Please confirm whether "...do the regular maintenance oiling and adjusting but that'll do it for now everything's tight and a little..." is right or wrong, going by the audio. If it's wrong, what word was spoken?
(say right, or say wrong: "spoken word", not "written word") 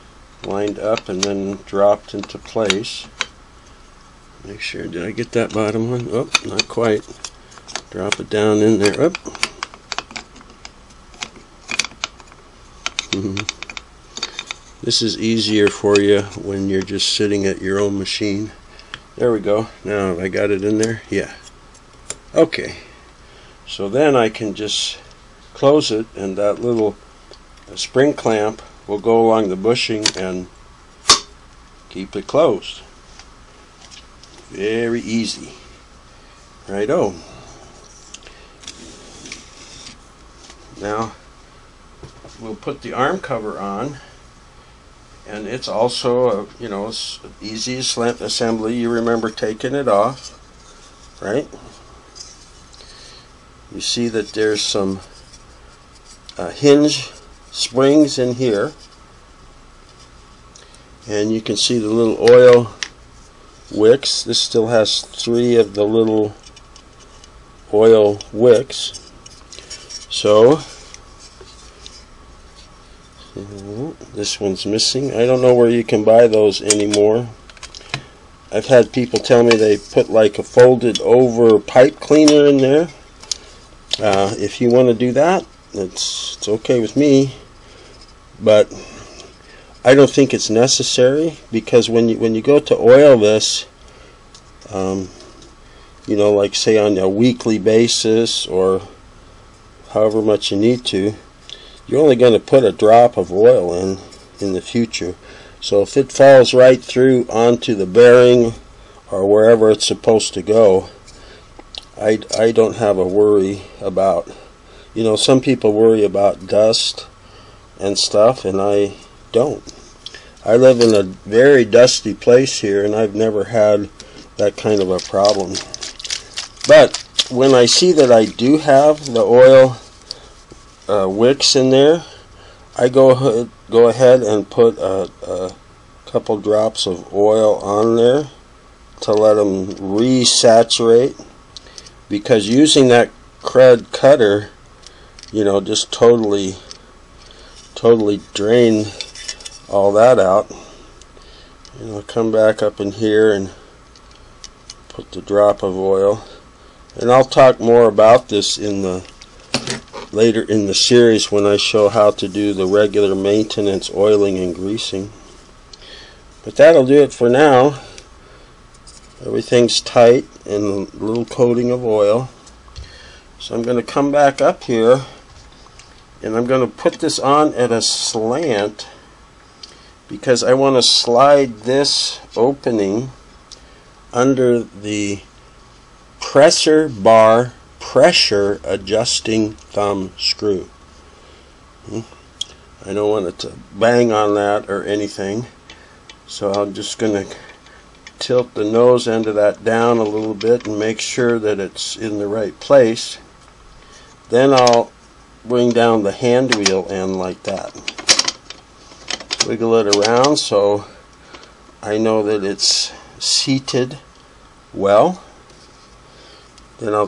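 wrong: "greasing", not "adjusting".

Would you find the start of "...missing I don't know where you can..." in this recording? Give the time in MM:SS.
01:14.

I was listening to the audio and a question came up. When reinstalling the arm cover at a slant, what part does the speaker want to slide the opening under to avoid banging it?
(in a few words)
presser bar pressure adjusting thumb screw.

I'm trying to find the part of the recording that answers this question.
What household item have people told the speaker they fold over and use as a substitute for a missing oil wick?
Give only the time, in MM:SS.
01:21.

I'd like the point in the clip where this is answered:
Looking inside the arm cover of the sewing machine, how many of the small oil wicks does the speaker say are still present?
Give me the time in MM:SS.
01:05.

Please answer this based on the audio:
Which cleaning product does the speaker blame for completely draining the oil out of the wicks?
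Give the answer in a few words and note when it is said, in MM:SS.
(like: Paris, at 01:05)
crud cutter, at 02:23.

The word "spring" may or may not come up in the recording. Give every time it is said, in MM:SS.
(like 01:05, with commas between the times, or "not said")
00:27, 00:57.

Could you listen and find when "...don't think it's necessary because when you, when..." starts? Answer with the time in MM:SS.
01:29.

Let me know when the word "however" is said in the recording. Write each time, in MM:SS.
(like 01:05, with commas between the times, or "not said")
01:39.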